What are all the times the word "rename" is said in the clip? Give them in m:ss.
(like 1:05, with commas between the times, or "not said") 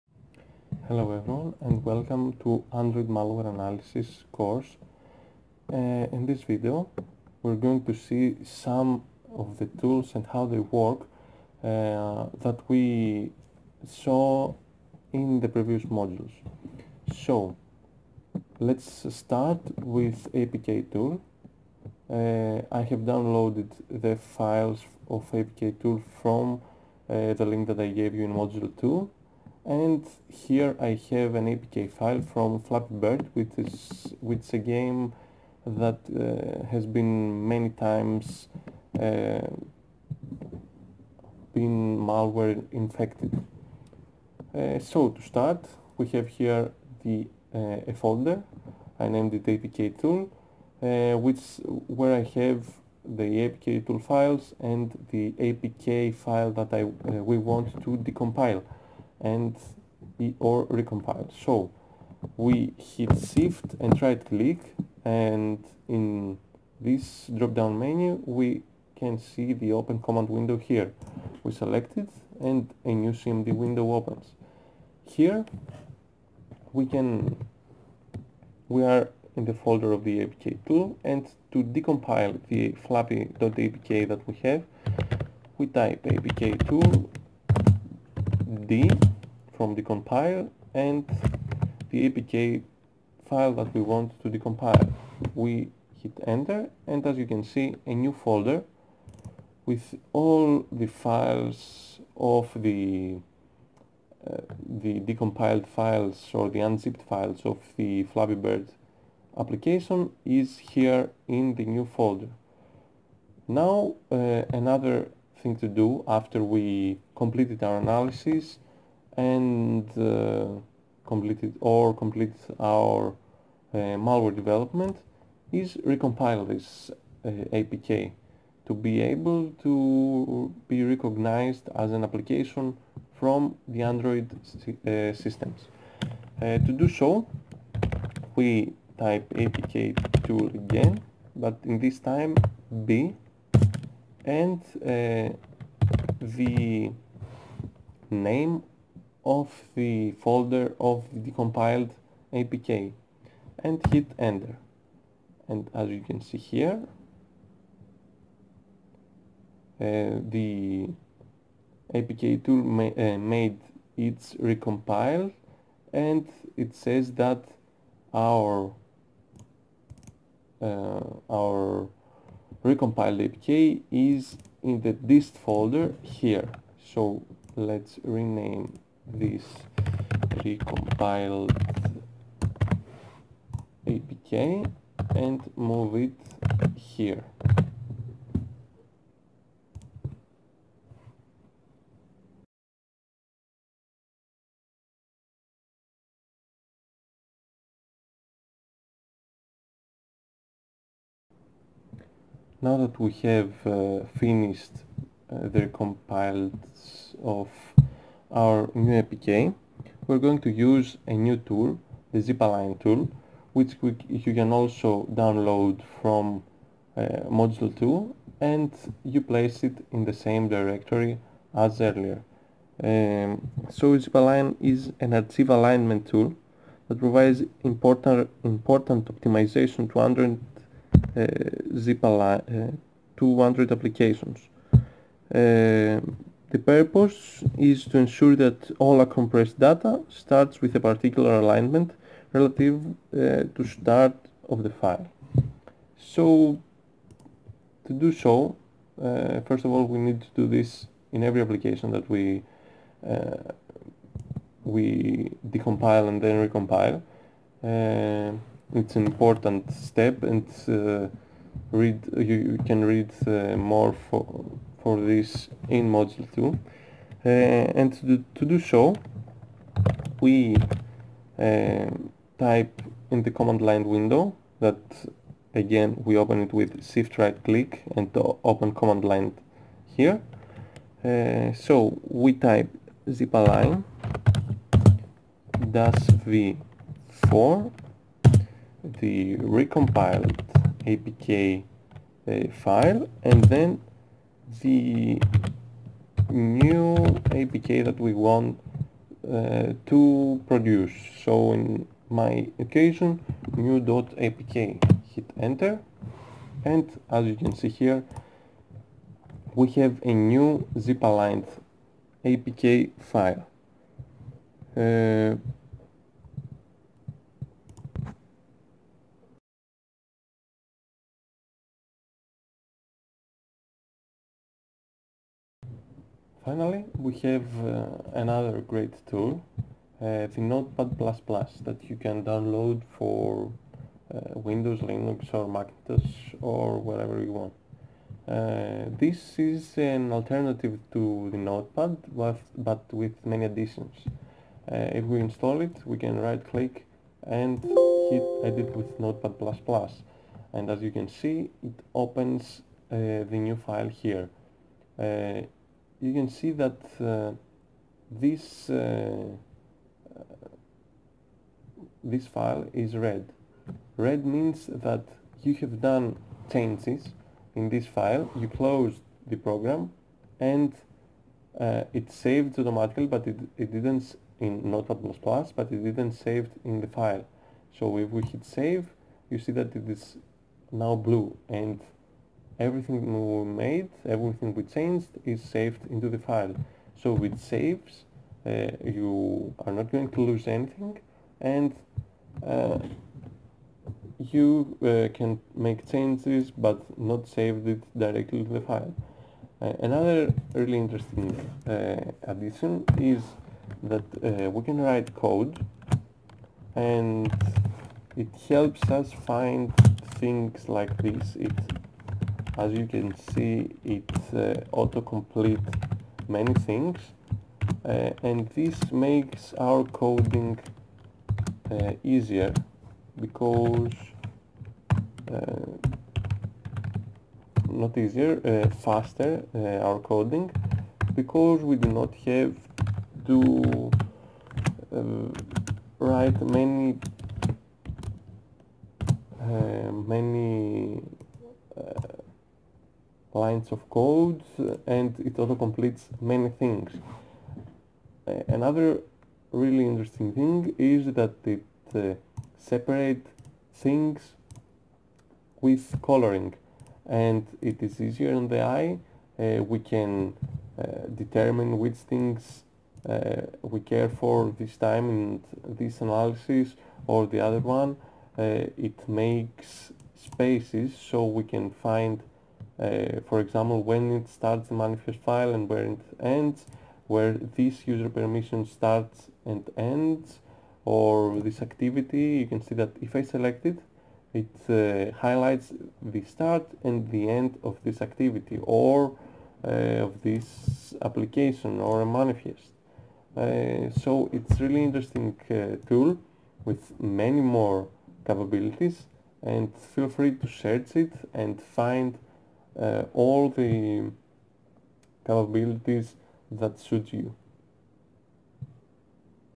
2:58.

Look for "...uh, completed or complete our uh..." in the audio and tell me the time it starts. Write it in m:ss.
1:59.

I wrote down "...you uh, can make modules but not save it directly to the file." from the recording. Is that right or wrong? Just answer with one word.
wrong.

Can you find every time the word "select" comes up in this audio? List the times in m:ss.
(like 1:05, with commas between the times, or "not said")
1:11, 8:03.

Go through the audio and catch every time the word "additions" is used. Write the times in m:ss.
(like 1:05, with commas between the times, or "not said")
5:43, 6:42.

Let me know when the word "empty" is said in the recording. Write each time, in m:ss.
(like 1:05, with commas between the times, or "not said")
not said.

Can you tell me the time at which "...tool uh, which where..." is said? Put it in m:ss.
0:50.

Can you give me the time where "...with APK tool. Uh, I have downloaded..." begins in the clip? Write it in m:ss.
0:19.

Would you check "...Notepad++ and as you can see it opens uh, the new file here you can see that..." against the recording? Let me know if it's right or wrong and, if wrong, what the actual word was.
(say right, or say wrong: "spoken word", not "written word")
right.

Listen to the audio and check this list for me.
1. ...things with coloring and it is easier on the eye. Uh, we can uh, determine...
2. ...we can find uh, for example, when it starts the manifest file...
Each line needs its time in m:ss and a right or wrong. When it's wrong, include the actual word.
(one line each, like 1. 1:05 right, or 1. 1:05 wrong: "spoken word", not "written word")
1. 7:33 right
2. 7:51 right.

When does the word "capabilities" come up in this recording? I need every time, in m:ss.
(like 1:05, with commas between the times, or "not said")
8:18, 8:25.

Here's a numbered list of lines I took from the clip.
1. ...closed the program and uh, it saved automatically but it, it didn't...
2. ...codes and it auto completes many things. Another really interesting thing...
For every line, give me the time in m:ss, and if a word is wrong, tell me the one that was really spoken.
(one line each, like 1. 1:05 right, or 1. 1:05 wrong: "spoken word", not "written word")
1. 6:08 right
2. 7:23 right.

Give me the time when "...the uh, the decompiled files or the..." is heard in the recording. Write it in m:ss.
1:42.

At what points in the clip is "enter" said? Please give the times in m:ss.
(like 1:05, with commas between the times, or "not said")
1:36, 2:34, 5:05.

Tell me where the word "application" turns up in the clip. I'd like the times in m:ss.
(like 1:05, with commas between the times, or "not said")
1:49, 2:12, 3:53, 4:11, 8:11.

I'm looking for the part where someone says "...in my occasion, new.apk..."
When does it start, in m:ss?
5:01.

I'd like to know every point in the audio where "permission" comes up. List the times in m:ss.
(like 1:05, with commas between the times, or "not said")
7:58.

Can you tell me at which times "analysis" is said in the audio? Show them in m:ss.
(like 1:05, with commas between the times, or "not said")
0:03, 1:57, 7:46.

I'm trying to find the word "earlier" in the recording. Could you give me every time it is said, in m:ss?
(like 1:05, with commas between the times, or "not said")
3:41.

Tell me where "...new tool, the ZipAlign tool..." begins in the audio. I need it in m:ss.
3:31.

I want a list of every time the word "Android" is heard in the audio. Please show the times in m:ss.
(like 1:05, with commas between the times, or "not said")
0:02, 2:13, 3:50.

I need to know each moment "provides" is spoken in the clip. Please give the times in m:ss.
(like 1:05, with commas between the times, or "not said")
3:46.